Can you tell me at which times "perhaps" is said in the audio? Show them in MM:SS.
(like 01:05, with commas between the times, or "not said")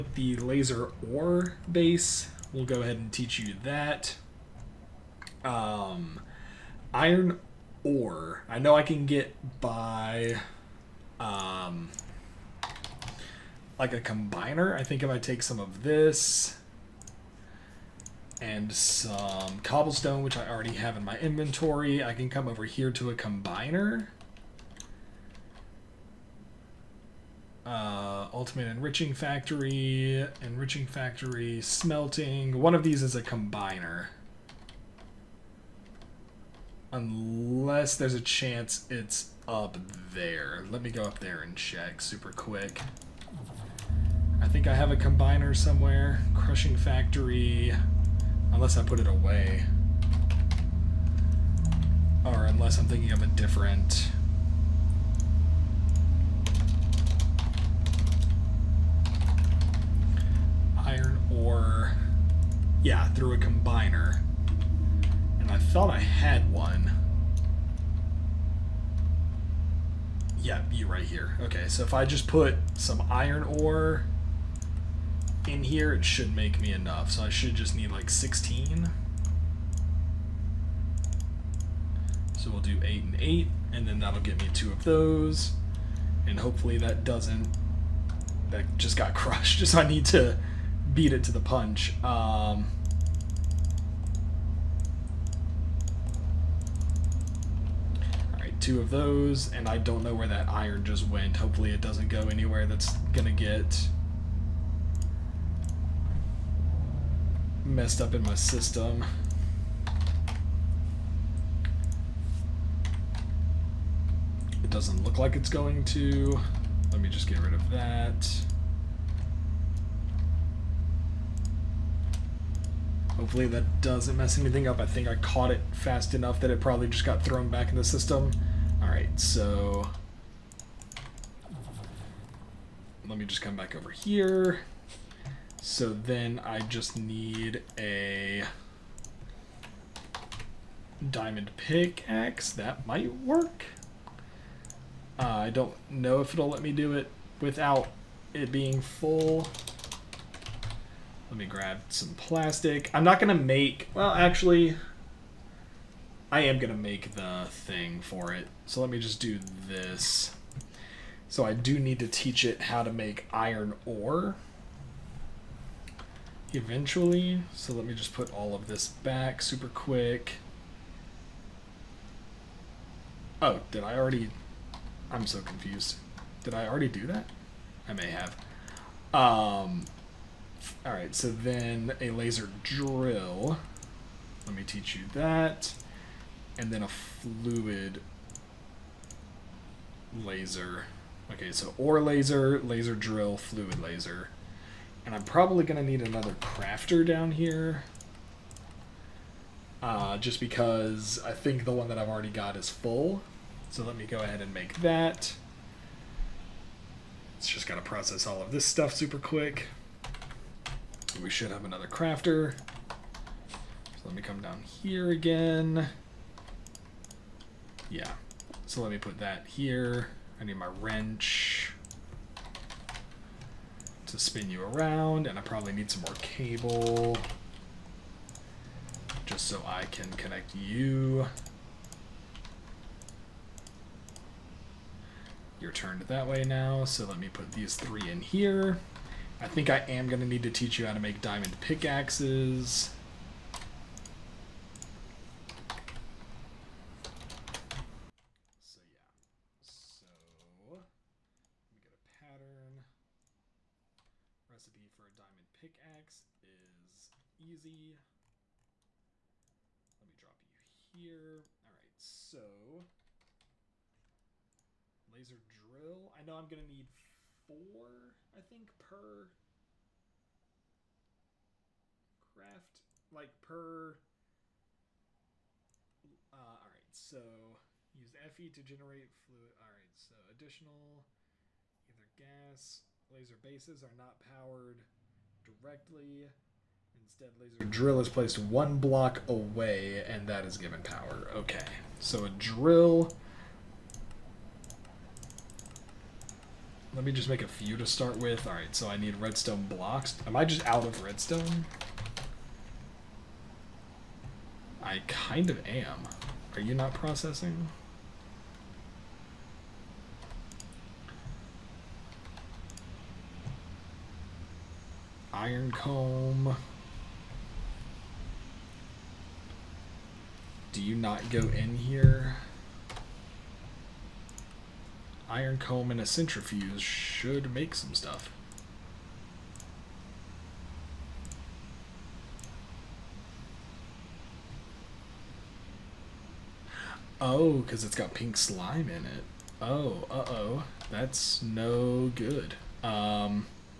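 not said.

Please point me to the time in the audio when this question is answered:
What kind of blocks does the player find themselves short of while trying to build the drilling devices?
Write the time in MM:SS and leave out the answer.
04:59.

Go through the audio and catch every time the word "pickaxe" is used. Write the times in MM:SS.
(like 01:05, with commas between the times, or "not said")
02:21, 04:01, 04:15.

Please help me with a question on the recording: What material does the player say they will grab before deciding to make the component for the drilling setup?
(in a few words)
plastic.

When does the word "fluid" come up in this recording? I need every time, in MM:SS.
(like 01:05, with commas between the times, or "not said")
03:06, 03:13, 04:39.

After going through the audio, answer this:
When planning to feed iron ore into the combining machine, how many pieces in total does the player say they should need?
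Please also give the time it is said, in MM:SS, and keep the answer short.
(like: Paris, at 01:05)
16, at 01:18.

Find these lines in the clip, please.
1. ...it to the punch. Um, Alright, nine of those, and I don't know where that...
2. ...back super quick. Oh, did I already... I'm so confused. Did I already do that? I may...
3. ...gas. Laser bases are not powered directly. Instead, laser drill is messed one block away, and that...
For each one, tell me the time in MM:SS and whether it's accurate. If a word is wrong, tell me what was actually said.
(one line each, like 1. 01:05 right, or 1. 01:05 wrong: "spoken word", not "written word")
1. 01:31 wrong: "two", not "nine"
2. 02:48 right
3. 04:42 wrong: "placed", not "messed".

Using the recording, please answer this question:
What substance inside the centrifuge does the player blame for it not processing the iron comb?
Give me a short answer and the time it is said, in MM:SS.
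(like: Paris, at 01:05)
pink slime, at 05:38.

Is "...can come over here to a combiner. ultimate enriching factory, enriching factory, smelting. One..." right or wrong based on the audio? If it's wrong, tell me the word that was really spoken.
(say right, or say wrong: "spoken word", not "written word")
right.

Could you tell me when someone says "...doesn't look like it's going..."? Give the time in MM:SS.
01:54.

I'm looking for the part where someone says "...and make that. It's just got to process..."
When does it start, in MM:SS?
03:24.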